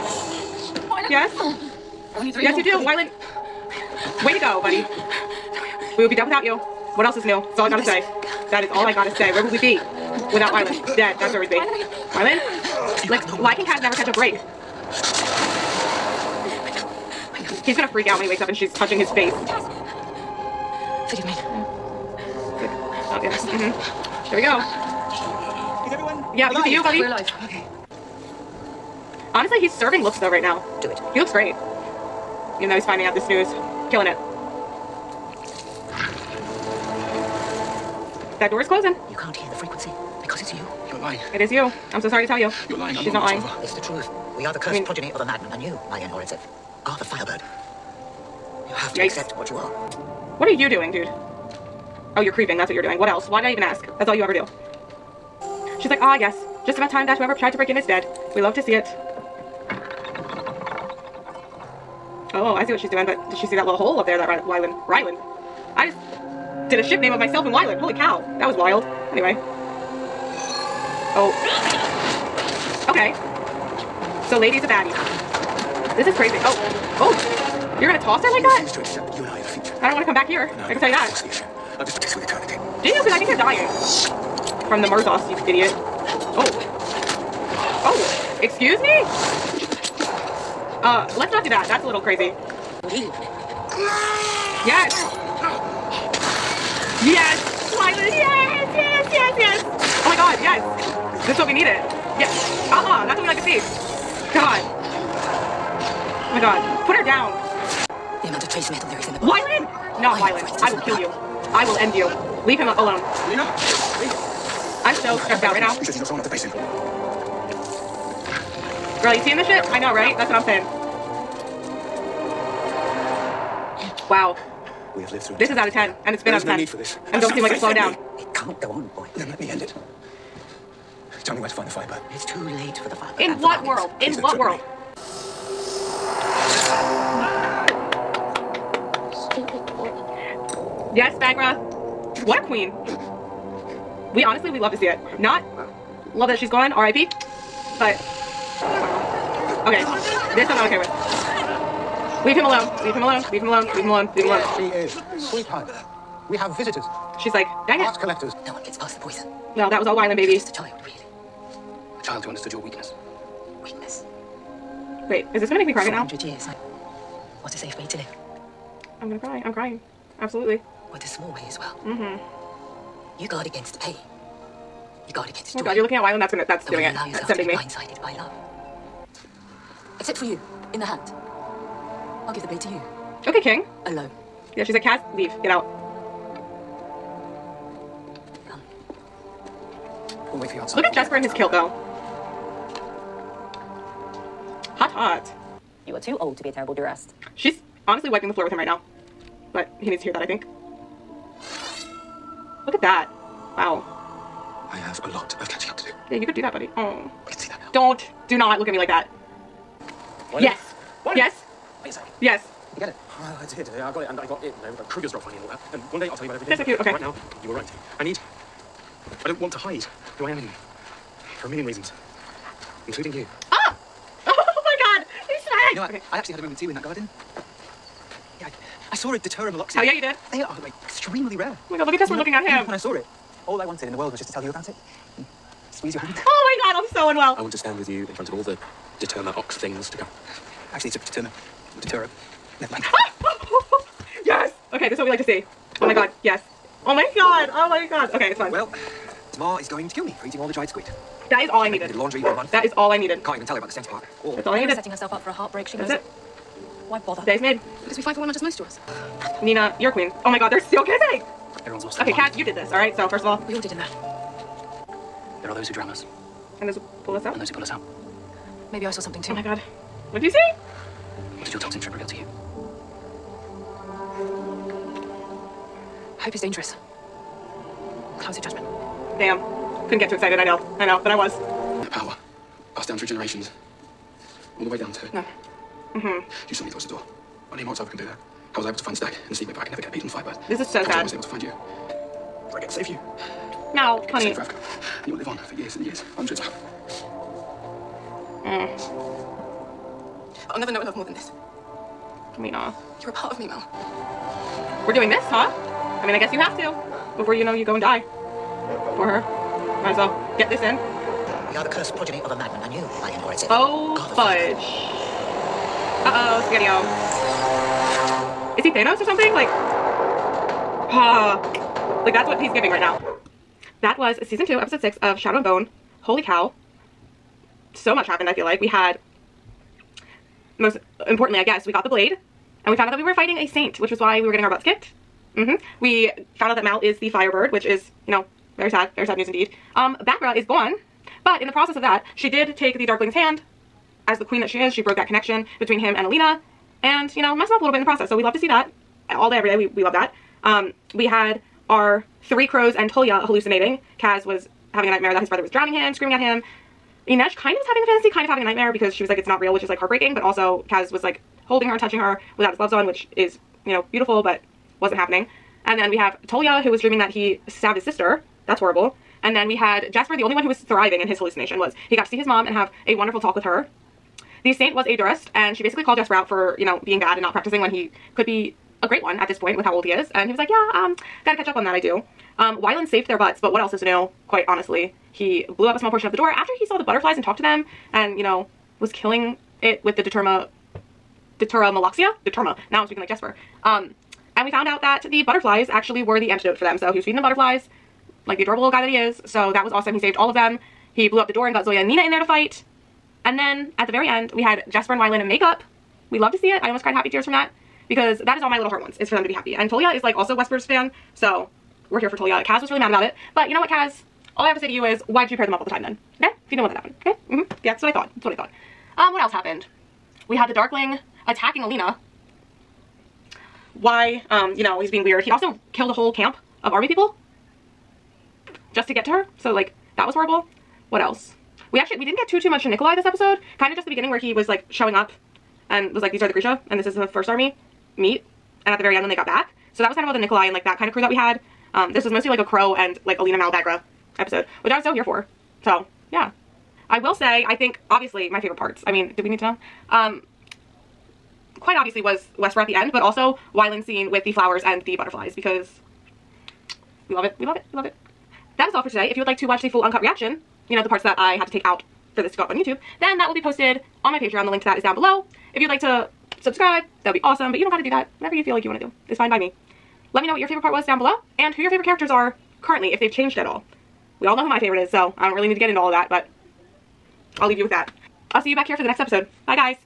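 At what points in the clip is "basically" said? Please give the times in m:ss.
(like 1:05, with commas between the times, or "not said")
6:15.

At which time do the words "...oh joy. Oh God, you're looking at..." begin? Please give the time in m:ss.
2:55.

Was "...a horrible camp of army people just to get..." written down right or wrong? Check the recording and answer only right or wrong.
wrong.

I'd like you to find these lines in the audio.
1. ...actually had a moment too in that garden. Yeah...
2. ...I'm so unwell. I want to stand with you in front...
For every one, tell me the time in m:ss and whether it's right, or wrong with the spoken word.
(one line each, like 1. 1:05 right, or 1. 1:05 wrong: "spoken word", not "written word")
1. 3:46 right
2. 3:56 right.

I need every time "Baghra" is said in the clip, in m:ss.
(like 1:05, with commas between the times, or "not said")
2:21, 5:39.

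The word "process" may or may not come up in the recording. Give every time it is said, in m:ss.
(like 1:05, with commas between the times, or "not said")
5:41, 5:47.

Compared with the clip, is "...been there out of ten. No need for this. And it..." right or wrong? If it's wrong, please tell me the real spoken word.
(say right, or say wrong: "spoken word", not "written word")
right.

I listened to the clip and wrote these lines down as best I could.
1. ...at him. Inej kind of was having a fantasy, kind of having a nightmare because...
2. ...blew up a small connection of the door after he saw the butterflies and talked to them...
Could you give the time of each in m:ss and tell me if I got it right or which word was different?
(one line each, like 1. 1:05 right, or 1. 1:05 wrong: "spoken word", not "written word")
1. 5:56 right
2. 6:25 wrong: "portion", not "connection".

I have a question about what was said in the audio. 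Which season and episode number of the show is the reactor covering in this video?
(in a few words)
Season 2, episode 6.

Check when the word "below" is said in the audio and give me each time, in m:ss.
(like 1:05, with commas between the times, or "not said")
7:44, 7:50.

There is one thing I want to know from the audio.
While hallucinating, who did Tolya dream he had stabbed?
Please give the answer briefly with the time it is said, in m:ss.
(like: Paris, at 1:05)
His sister, at 6:07.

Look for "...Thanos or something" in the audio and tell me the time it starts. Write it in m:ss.
5:18.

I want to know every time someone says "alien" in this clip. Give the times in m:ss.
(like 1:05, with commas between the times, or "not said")
5:12.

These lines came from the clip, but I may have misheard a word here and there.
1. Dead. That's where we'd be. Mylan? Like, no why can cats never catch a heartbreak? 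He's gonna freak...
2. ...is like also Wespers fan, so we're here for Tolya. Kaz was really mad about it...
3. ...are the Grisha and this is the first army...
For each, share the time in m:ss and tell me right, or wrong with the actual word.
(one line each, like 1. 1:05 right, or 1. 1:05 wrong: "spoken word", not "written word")
1. 0:10 wrong: "break", not "heartbreak"
2. 6:49 right
3. 7:16 right.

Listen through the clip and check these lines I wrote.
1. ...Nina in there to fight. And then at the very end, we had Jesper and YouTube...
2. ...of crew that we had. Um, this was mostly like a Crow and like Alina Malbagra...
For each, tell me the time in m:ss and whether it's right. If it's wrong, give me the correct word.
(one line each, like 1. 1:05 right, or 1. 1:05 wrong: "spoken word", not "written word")
1. 6:41 wrong: "Wylan", not "YouTube"
2. 7:20 right.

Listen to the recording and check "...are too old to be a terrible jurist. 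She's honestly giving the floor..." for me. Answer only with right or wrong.
wrong.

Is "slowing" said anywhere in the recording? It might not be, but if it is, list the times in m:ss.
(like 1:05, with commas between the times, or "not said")
2:07.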